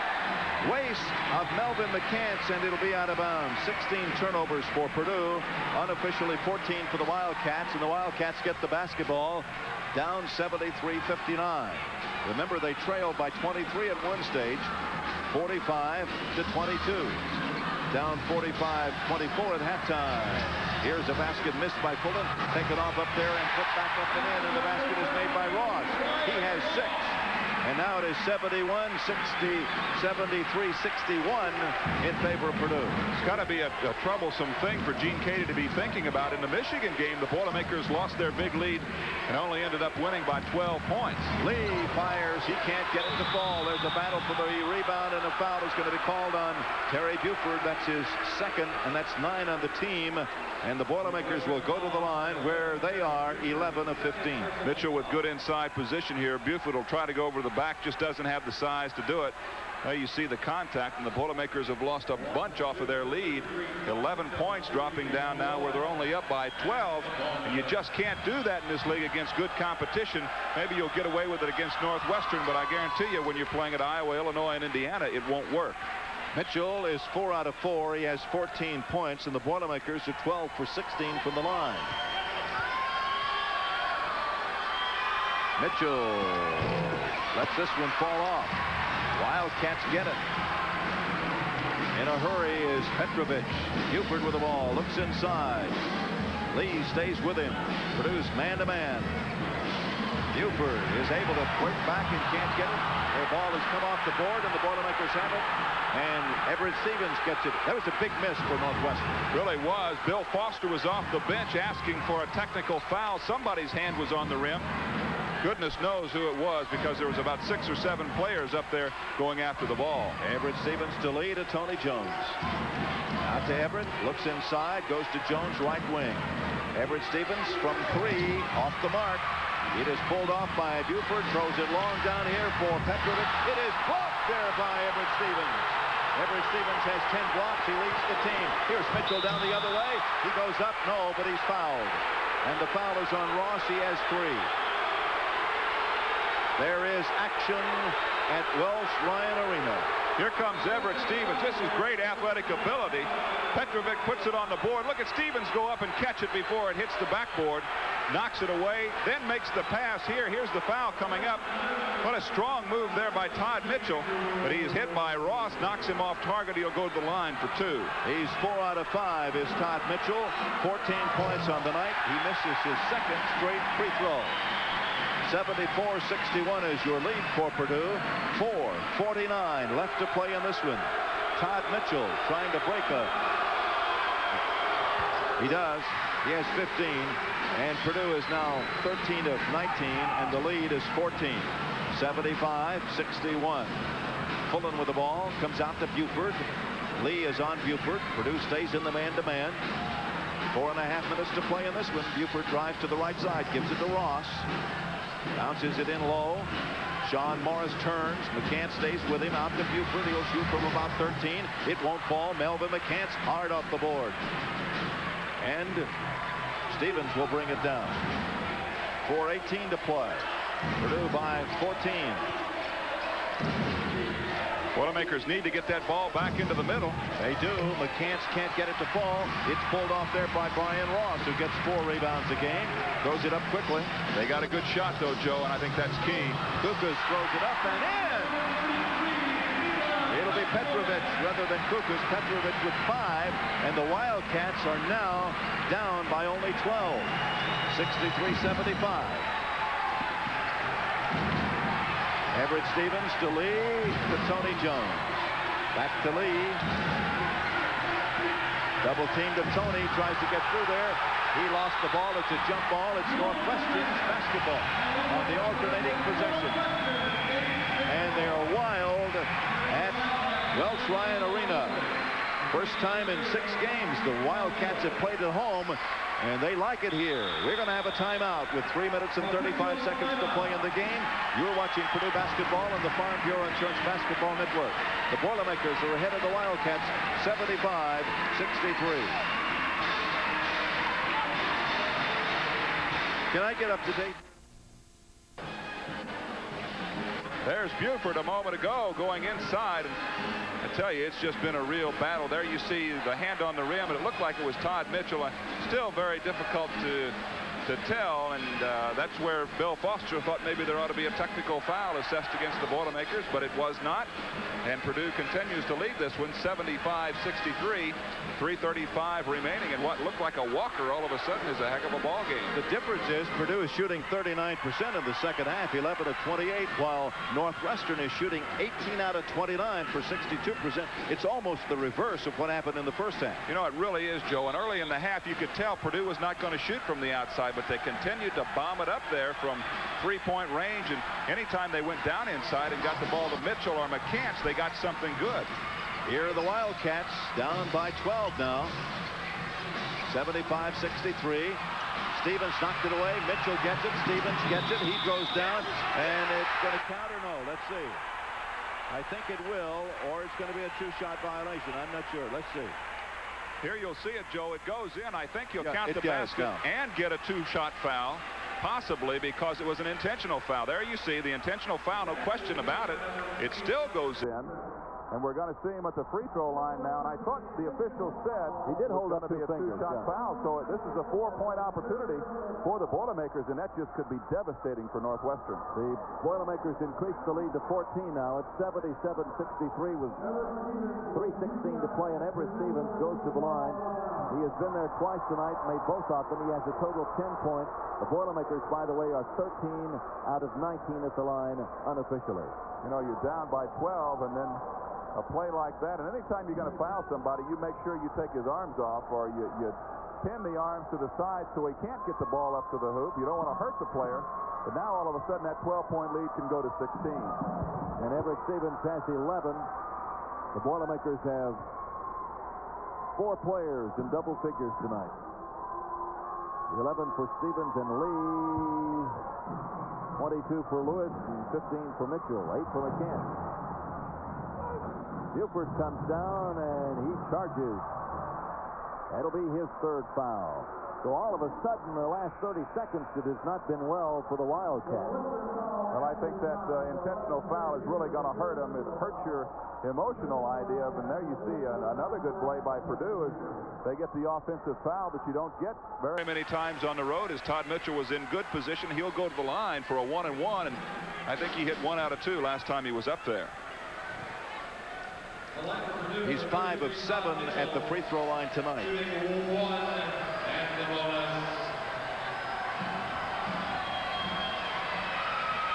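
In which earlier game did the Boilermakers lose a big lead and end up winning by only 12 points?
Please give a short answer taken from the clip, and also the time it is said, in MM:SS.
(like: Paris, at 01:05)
Michigan, at 00:36.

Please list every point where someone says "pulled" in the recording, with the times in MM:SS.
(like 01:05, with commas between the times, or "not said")
02:10, 03:49.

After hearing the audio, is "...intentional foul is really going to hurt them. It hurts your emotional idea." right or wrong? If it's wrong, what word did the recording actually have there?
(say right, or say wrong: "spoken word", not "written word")
right.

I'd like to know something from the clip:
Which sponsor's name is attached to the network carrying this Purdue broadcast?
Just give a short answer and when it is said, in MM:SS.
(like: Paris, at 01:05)
Farm Bureau Insurance, at 04:42.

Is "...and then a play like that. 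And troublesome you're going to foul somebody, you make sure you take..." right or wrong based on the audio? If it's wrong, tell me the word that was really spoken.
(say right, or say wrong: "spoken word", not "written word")
wrong: "anytime", not "troublesome".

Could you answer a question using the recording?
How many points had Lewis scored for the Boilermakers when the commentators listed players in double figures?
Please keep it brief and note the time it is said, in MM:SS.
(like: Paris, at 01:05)
22, at 07:10.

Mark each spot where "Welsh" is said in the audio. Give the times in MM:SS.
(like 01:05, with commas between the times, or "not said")
02:28, 04:30.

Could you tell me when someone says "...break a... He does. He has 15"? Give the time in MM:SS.
03:02.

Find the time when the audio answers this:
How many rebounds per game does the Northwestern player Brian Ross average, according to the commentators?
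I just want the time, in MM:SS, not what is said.
03:51.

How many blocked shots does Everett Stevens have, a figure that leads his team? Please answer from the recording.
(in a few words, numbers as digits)
10.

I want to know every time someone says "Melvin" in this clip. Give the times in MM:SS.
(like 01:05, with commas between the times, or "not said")
00:01, 03:32.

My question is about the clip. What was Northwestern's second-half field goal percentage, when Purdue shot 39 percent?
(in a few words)
62%.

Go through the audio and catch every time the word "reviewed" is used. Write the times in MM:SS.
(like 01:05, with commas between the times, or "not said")
not said.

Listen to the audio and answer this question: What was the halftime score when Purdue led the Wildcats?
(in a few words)
45-24.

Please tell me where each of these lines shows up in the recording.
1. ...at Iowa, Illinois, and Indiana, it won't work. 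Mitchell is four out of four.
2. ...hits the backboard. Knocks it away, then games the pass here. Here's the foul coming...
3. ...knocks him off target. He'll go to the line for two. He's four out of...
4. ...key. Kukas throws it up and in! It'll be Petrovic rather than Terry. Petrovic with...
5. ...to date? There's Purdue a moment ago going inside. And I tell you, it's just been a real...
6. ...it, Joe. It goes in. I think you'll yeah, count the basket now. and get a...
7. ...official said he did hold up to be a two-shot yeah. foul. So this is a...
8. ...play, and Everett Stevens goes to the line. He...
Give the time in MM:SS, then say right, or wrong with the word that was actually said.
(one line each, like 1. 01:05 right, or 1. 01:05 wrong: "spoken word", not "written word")
1. 01:13 right
2. 02:36 wrong: "makes", not "games"
3. 02:45 right
4. 03:56 wrong: "Kukas", not "Terry"
5. 04:53 wrong: "Buford", not "Purdue"
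6. 06:04 right
7. 06:17 right
8. 06:31 right.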